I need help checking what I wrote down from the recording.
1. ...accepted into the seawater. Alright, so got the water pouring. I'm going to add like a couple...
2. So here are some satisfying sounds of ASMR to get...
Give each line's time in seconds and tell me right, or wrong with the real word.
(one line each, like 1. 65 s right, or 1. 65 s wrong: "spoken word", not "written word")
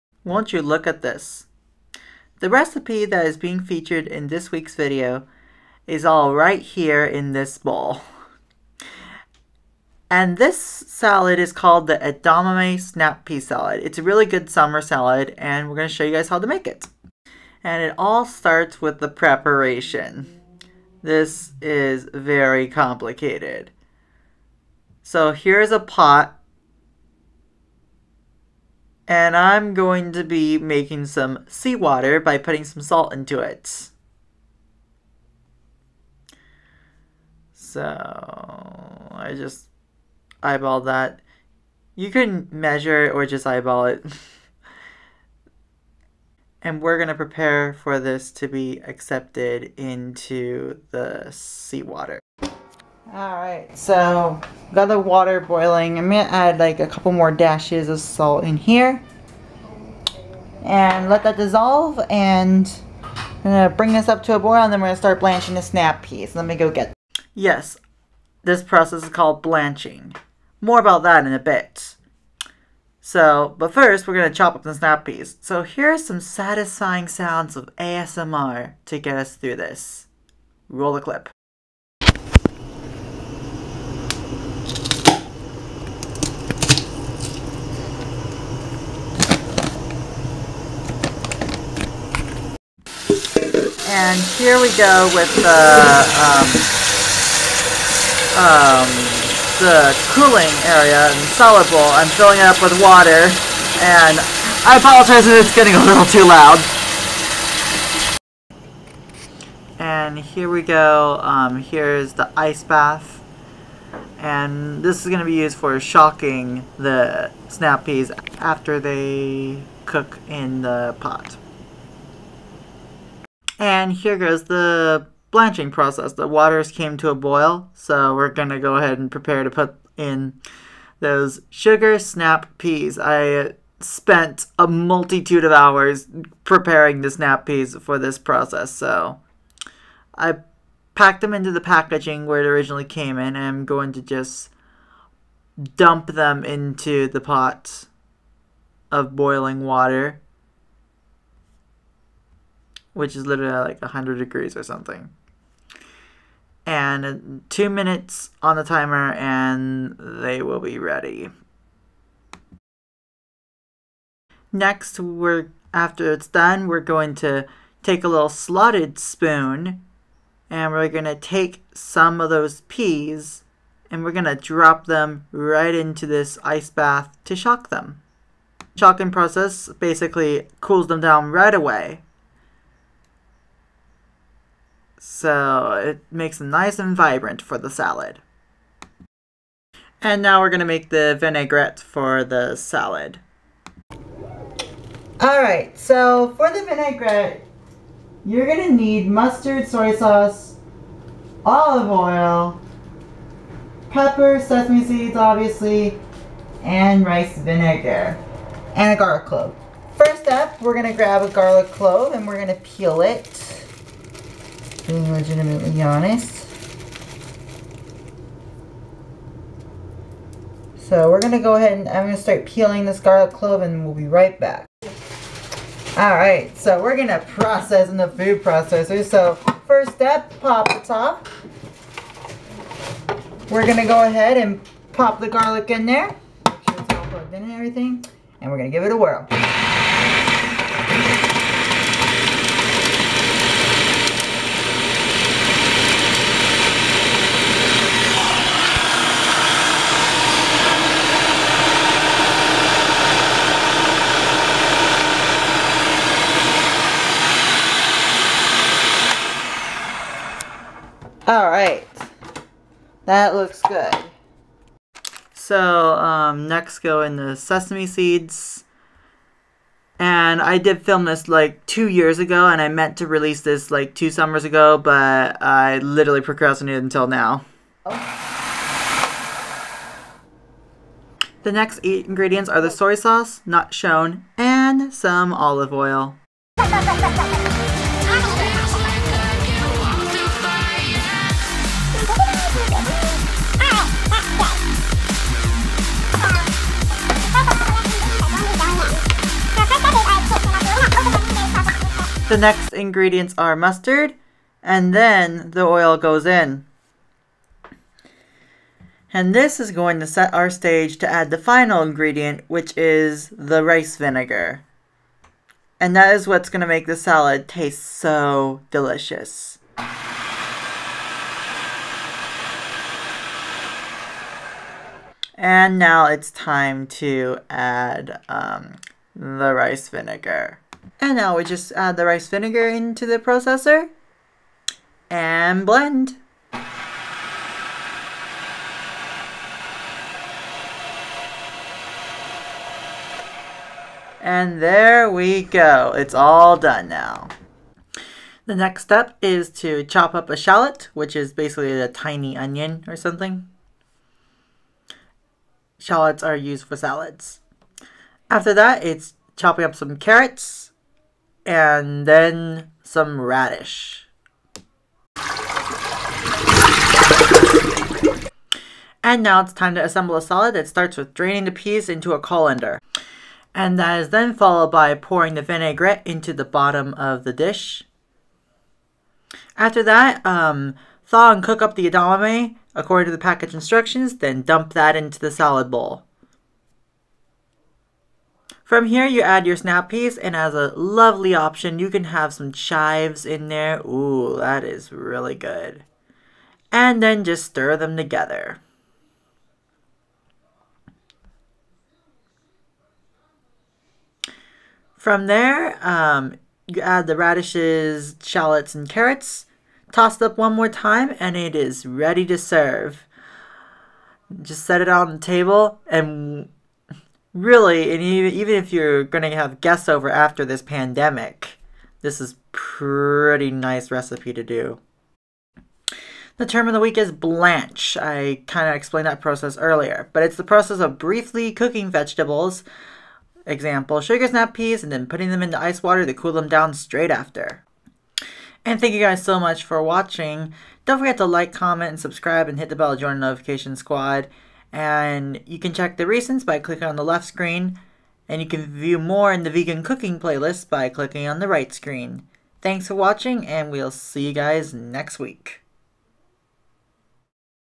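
1. 48 s wrong: "boiling", not "pouring"
2. 75 s right.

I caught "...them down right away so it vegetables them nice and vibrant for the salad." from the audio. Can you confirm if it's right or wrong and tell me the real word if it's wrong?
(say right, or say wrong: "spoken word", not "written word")
wrong: "makes", not "vegetables".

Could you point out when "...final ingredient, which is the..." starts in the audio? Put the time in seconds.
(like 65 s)
311 s.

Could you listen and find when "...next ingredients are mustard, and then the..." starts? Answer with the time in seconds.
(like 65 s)
302 s.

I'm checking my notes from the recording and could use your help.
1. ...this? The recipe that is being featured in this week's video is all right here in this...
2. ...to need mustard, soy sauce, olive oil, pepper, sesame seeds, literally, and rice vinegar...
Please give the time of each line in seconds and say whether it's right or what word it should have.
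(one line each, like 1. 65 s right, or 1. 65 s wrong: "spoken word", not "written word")
1. 1 s right
2. 198 s wrong: "obviously", not "literally".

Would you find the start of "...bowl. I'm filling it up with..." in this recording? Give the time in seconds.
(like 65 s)
101 s.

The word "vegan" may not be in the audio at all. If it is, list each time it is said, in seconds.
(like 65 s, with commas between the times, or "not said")
449 s.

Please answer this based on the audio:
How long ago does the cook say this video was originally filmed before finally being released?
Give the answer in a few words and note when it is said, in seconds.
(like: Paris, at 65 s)
2 years, at 271 s.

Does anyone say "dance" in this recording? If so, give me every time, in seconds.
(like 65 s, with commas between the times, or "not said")
not said.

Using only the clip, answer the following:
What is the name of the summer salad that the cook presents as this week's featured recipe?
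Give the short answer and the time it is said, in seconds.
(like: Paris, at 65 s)
Edamame snap pea salad, at 11 s.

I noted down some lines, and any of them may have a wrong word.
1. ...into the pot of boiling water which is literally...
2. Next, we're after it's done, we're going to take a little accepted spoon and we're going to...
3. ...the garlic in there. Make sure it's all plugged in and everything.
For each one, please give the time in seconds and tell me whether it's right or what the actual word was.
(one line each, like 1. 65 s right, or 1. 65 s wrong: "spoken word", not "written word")
1. 146 s right
2. 164 s wrong: "slotted", not "accepted"
3. 235 s right.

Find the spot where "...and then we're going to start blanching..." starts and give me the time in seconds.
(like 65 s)
64 s.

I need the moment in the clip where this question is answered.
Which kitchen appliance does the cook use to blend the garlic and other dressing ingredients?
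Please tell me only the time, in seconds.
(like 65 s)
228 s.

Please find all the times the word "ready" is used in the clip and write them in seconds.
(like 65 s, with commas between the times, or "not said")
160 s, 411 s.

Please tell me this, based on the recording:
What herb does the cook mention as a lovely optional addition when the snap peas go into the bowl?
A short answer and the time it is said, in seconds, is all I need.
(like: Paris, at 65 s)
Chives, at 392 s.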